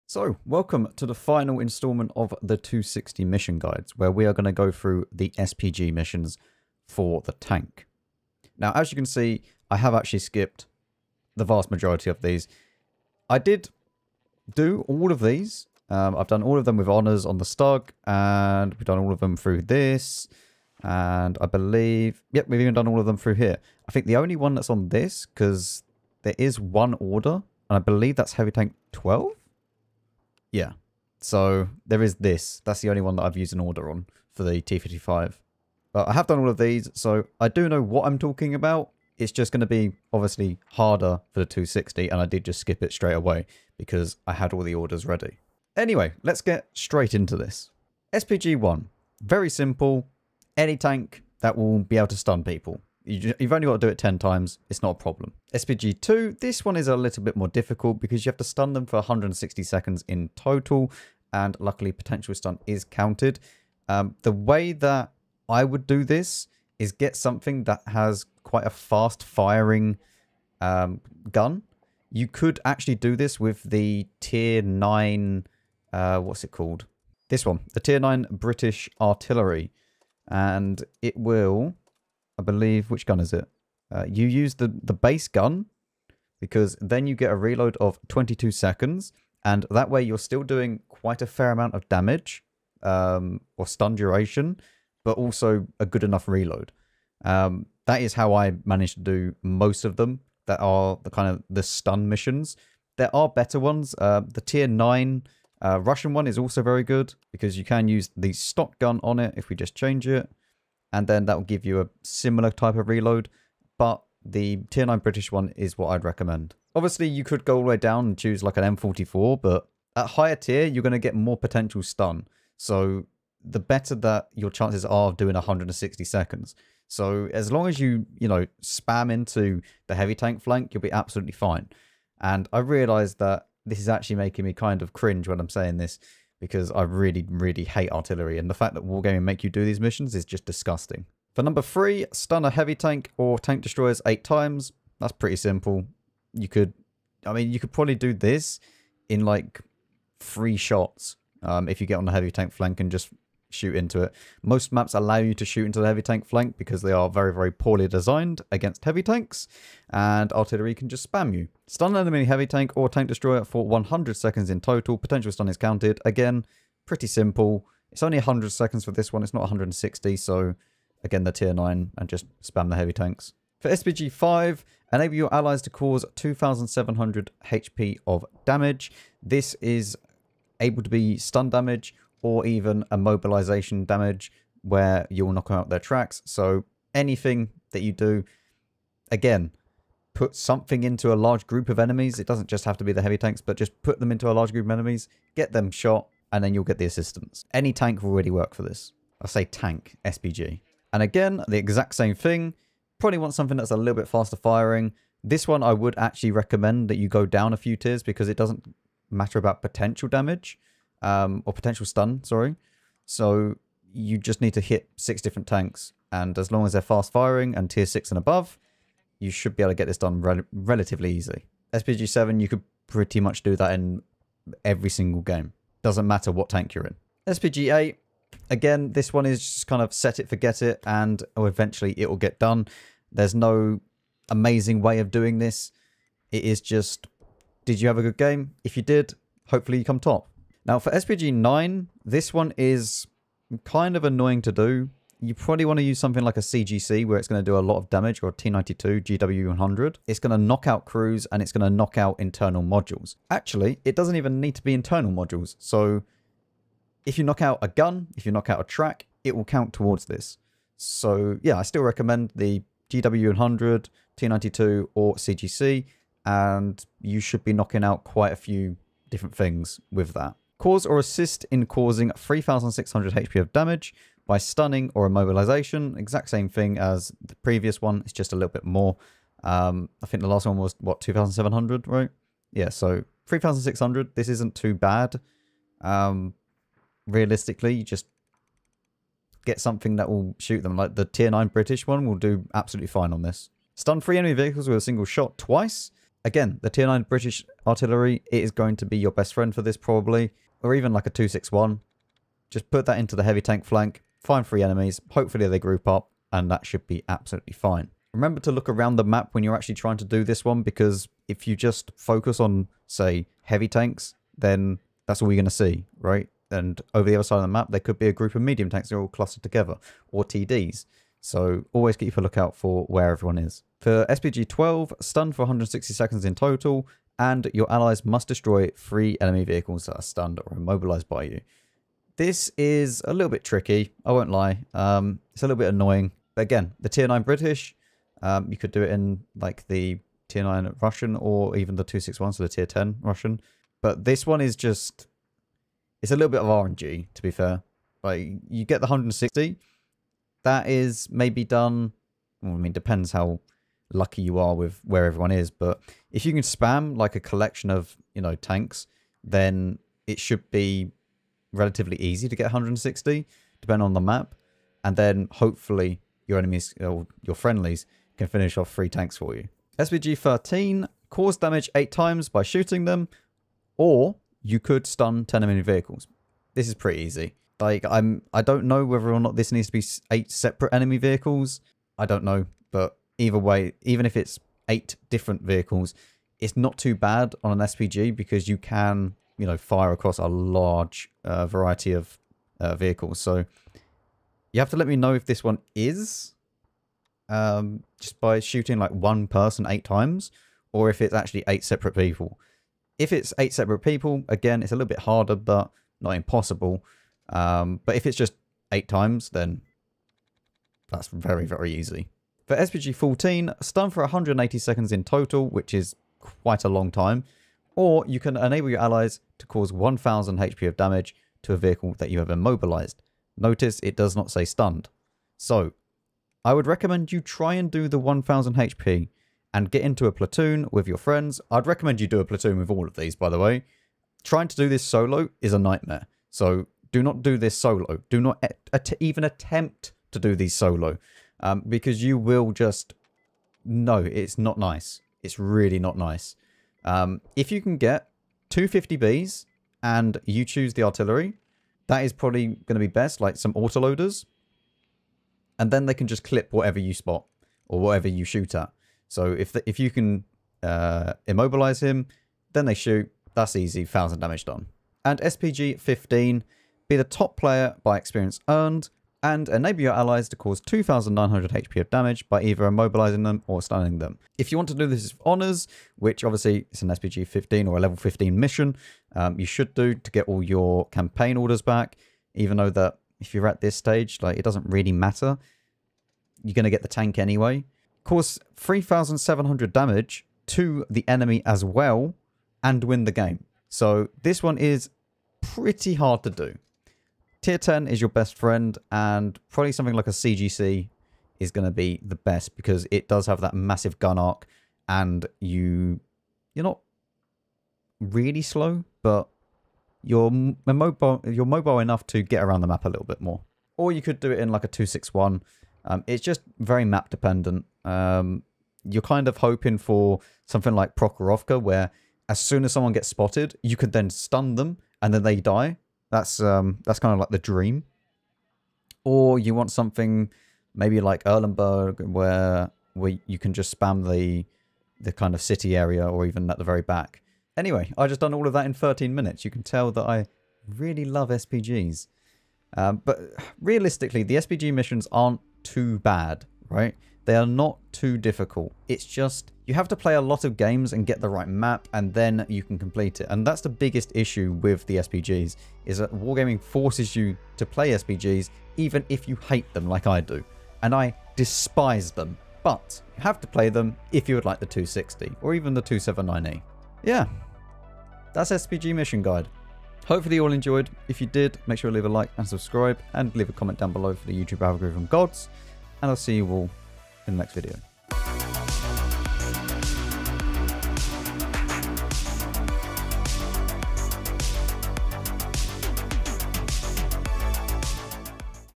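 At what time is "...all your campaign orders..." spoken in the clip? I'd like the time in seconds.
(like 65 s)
480 s.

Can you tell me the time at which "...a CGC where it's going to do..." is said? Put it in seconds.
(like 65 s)
246 s.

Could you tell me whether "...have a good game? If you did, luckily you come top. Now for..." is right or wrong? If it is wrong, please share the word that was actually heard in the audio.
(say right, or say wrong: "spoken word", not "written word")
wrong: "hopefully", not "luckily".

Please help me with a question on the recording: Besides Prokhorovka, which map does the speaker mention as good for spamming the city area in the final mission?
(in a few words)
Erlenberg.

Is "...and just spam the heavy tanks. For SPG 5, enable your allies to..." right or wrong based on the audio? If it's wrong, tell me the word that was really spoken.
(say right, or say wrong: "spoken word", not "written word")
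right.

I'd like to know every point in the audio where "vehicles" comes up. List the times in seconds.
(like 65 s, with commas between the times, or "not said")
294 s, 329 s, 375 s, 380 s, 385 s, 392 s, 421 s.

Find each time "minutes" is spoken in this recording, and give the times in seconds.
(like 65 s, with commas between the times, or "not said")
539 s.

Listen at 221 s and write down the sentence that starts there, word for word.
SPG 7, you could pretty much do that in every single game.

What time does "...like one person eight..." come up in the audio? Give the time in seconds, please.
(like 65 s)
398 s.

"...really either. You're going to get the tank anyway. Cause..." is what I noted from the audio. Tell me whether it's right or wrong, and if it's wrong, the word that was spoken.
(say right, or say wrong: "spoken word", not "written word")
wrong: "matter", not "either".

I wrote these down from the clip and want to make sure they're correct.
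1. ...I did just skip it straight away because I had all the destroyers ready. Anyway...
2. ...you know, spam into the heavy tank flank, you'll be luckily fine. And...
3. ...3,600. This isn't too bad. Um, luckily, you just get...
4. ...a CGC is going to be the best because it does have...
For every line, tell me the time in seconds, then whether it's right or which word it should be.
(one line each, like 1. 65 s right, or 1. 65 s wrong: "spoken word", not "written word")
1. 42 s wrong: "orders", not "destroyers"
2. 128 s wrong: "absolutely", not "luckily"
3. 283 s wrong: "realistically", not "luckily"
4. 500 s right.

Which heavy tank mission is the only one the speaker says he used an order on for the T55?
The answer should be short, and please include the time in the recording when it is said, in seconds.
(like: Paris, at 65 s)
Heavy Tank 12, at 28 s.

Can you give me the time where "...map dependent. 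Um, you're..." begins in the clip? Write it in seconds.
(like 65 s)
516 s.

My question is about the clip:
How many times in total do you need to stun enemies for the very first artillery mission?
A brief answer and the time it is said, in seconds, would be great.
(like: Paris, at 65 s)
10, at 53 s.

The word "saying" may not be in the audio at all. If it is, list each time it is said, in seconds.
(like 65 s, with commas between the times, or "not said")
135 s.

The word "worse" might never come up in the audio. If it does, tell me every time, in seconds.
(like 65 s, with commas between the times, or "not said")
not said.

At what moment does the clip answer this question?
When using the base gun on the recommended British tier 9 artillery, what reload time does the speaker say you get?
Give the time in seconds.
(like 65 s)
88 s.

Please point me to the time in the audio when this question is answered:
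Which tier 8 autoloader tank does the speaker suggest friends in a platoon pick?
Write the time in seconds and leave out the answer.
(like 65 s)
448 s.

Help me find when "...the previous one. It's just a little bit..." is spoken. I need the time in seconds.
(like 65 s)
277 s.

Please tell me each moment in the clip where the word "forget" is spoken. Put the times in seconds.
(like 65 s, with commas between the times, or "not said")
230 s.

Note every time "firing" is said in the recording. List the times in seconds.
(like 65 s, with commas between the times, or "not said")
69 s, 204 s, 217 s.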